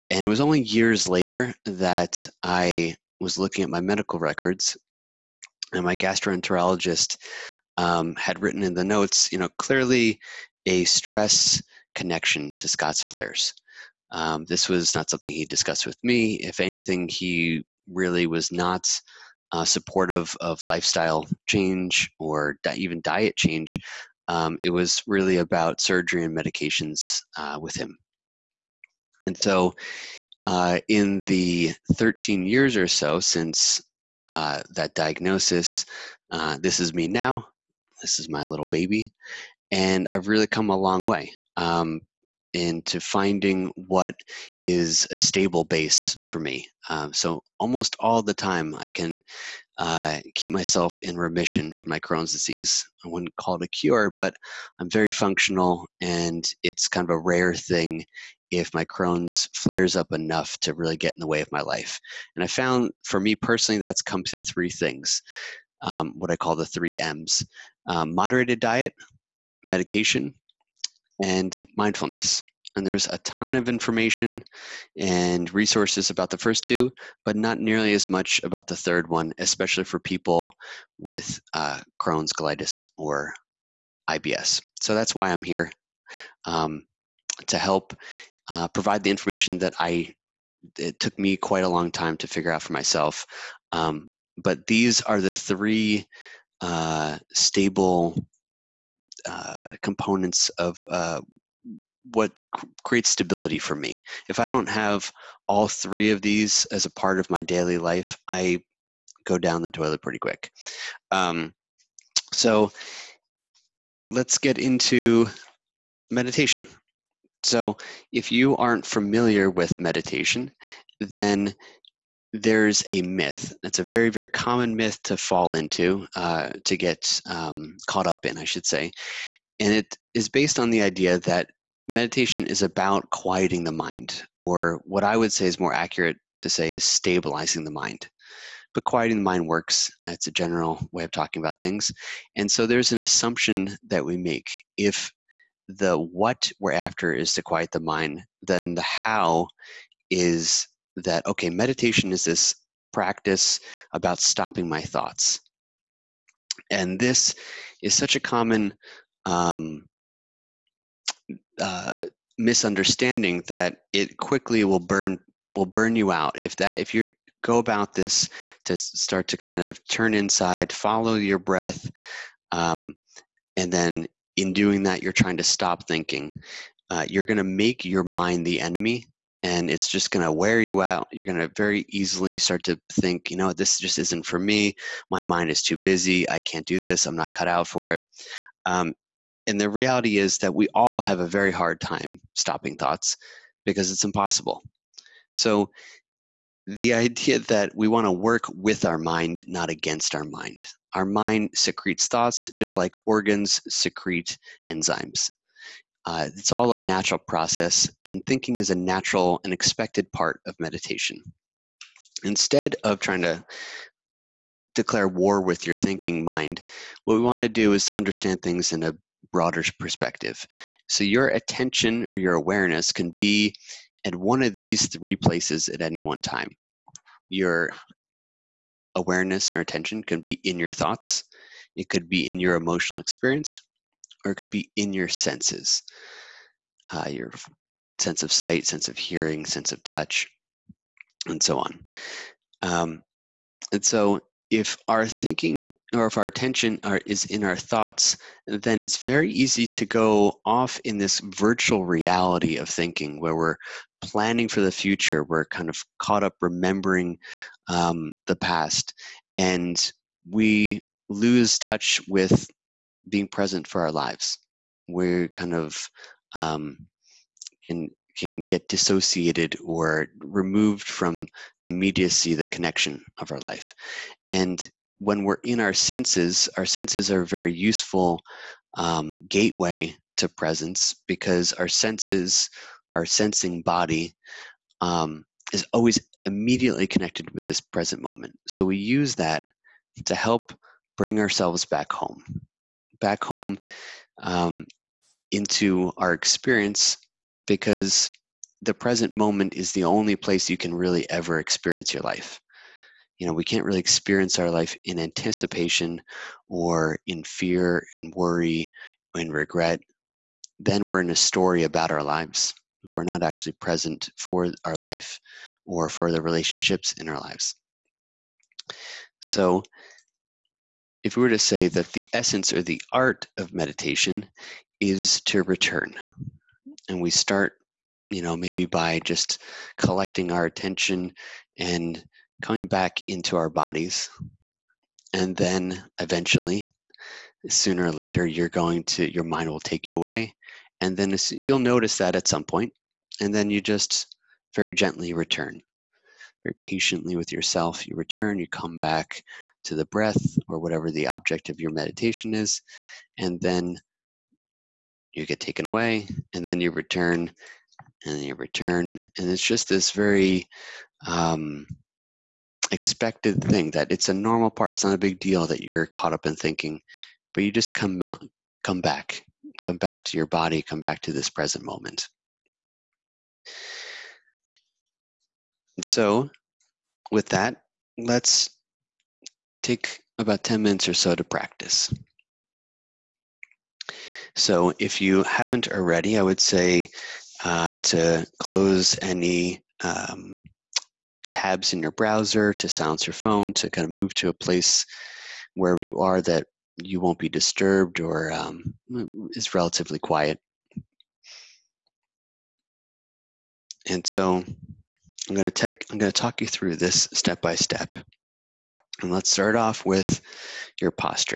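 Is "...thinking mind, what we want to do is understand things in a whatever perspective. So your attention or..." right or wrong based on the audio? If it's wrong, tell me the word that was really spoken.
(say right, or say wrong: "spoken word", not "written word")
wrong: "broader", not "whatever".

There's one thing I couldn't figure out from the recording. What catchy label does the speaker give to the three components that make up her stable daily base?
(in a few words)
the three M's.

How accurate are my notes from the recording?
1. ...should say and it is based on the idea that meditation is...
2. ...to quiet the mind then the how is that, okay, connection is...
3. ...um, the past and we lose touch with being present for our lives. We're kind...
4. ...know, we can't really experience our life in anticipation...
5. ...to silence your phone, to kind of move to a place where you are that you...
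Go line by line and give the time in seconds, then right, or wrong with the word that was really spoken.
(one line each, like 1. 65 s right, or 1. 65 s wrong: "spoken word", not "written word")
1. 128 s right
2. 147 s wrong: "meditation", not "connection"
3. 257 s right
4. 303 s right
5. 392 s right.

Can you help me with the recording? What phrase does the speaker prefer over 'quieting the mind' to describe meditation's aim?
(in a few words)
stabilizing the mind.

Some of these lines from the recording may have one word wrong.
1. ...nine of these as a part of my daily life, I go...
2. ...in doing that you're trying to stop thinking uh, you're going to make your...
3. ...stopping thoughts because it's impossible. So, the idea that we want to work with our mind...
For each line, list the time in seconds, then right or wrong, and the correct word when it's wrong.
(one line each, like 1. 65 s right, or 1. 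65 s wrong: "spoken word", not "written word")
1. 105 s wrong: "three", not "nine"
2. 174 s right
3. 192 s right.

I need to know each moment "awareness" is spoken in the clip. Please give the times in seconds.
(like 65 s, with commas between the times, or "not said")
222 s, 228 s.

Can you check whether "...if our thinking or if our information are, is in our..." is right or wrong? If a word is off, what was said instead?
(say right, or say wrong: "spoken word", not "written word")
wrong: "attention", not "information".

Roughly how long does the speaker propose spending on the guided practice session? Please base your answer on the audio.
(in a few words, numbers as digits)
10 minutes.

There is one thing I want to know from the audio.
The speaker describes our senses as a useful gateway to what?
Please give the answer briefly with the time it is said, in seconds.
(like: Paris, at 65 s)
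presence, at 280 s.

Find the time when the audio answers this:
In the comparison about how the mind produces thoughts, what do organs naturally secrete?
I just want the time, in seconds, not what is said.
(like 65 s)
204 s.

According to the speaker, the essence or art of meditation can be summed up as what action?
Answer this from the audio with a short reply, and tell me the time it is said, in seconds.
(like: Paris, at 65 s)
to return, at 325 s.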